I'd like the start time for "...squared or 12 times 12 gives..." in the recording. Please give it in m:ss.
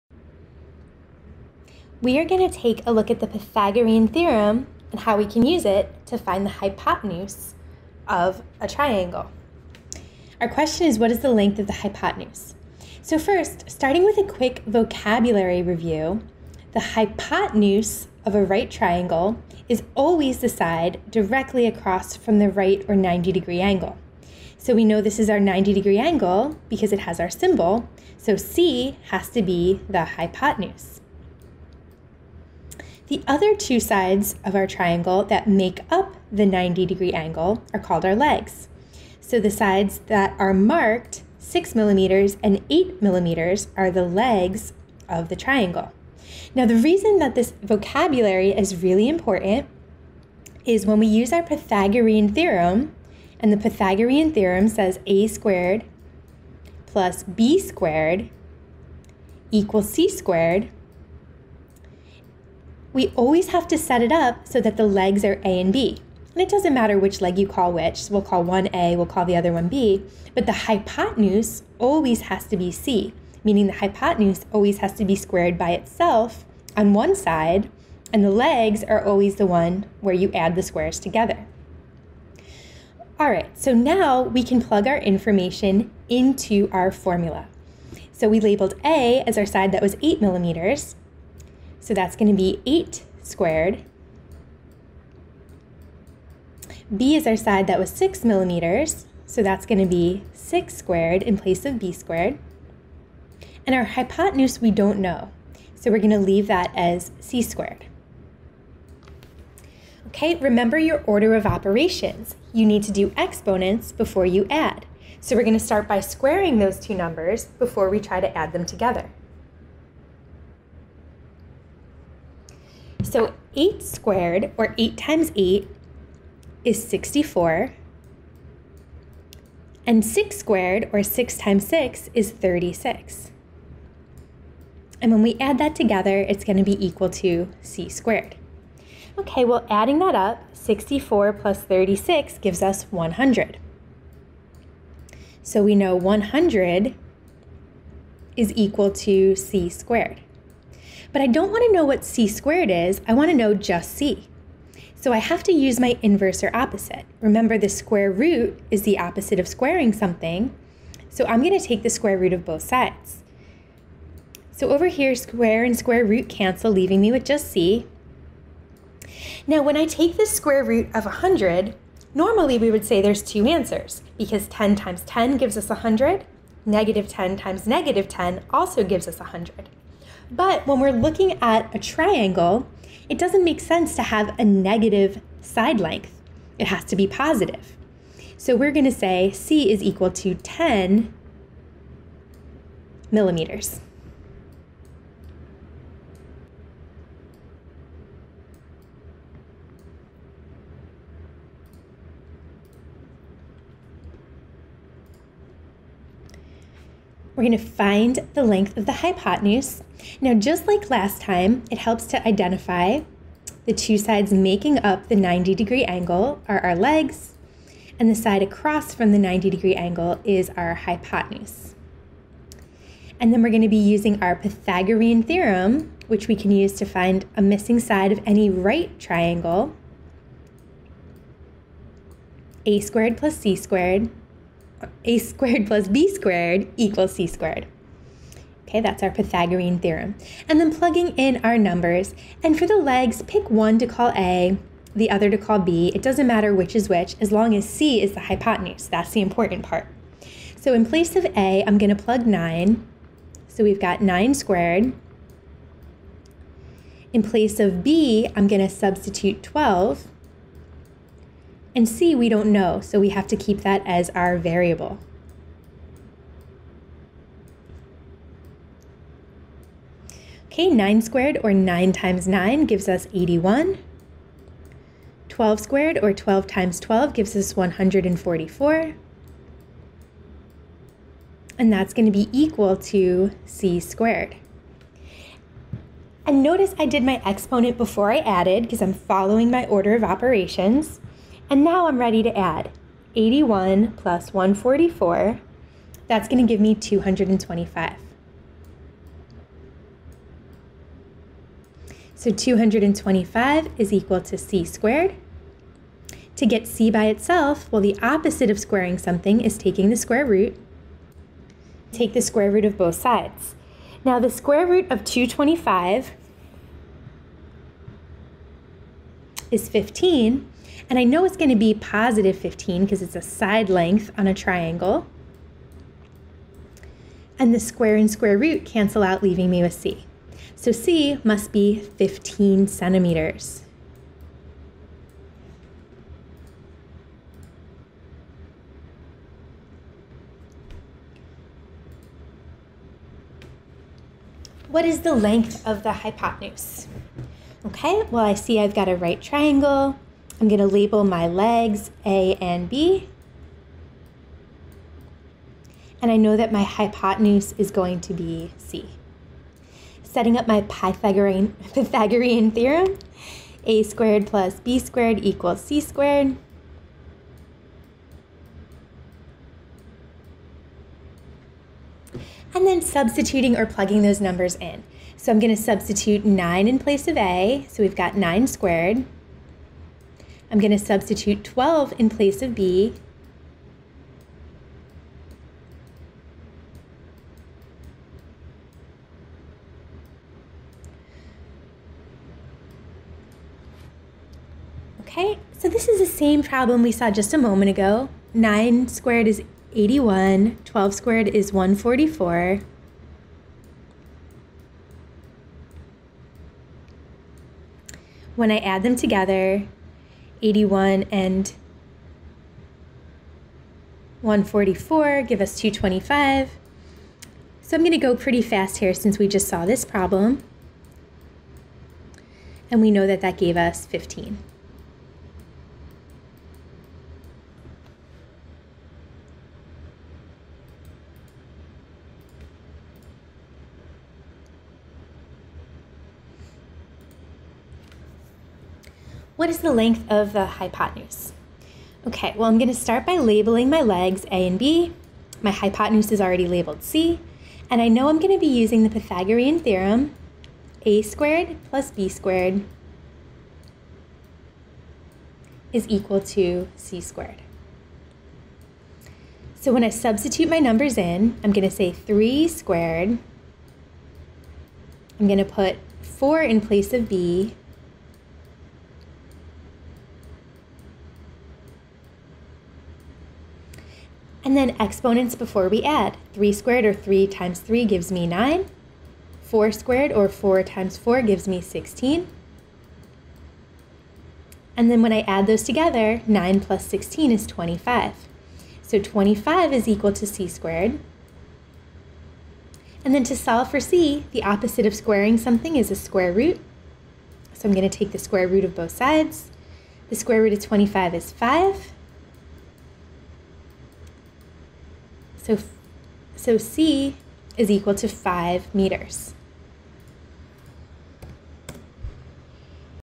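4:35.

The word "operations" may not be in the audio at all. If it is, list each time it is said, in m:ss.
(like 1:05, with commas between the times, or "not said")
1:51, 4:50.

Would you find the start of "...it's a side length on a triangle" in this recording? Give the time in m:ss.
5:23.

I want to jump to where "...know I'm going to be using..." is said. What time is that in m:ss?
7:27.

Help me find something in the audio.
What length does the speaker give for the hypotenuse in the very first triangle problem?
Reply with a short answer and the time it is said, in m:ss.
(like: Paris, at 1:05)
10 millimeters, at 3:10.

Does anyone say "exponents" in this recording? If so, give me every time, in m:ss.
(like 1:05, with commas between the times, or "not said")
1:53, 4:47, 7:54.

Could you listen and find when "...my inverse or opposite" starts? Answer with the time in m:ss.
2:35.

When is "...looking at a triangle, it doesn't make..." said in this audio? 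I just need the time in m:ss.
3:00.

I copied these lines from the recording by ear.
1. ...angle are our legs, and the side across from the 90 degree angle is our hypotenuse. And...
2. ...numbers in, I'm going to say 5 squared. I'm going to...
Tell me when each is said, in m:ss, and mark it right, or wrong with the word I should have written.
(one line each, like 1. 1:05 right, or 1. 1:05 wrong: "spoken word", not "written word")
1. 3:35 right
2. 7:40 wrong: "3", not "5".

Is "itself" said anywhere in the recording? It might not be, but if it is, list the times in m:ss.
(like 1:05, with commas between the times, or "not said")
1:15, 5:07.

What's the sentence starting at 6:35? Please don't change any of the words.
Okay, so this is the same problem we saw just a moment ago.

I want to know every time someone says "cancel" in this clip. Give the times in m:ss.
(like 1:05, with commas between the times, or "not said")
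2:46, 5:28.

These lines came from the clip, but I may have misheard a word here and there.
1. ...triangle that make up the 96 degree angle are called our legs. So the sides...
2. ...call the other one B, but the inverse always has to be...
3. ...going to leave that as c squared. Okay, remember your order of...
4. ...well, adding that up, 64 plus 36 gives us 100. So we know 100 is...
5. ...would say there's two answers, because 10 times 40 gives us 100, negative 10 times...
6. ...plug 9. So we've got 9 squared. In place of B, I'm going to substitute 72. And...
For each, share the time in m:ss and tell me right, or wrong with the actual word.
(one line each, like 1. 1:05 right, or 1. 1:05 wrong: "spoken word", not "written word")
1. 0:34 wrong: "90", not "96"
2. 1:09 wrong: "hypotenuse", not "inverse"
3. 1:45 right
4. 2:19 right
5. 2:52 wrong: "10", not "40"
6. 4:12 wrong: "12", not "72".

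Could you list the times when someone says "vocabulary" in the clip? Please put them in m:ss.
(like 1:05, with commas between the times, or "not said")
0:14, 0:47.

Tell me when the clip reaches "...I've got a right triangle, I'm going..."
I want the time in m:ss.
5:48.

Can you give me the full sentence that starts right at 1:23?
All right, so now we can plug our information into our formula.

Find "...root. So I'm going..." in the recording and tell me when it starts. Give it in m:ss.
8:16.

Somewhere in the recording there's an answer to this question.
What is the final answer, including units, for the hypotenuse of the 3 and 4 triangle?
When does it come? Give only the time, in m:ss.
8:28.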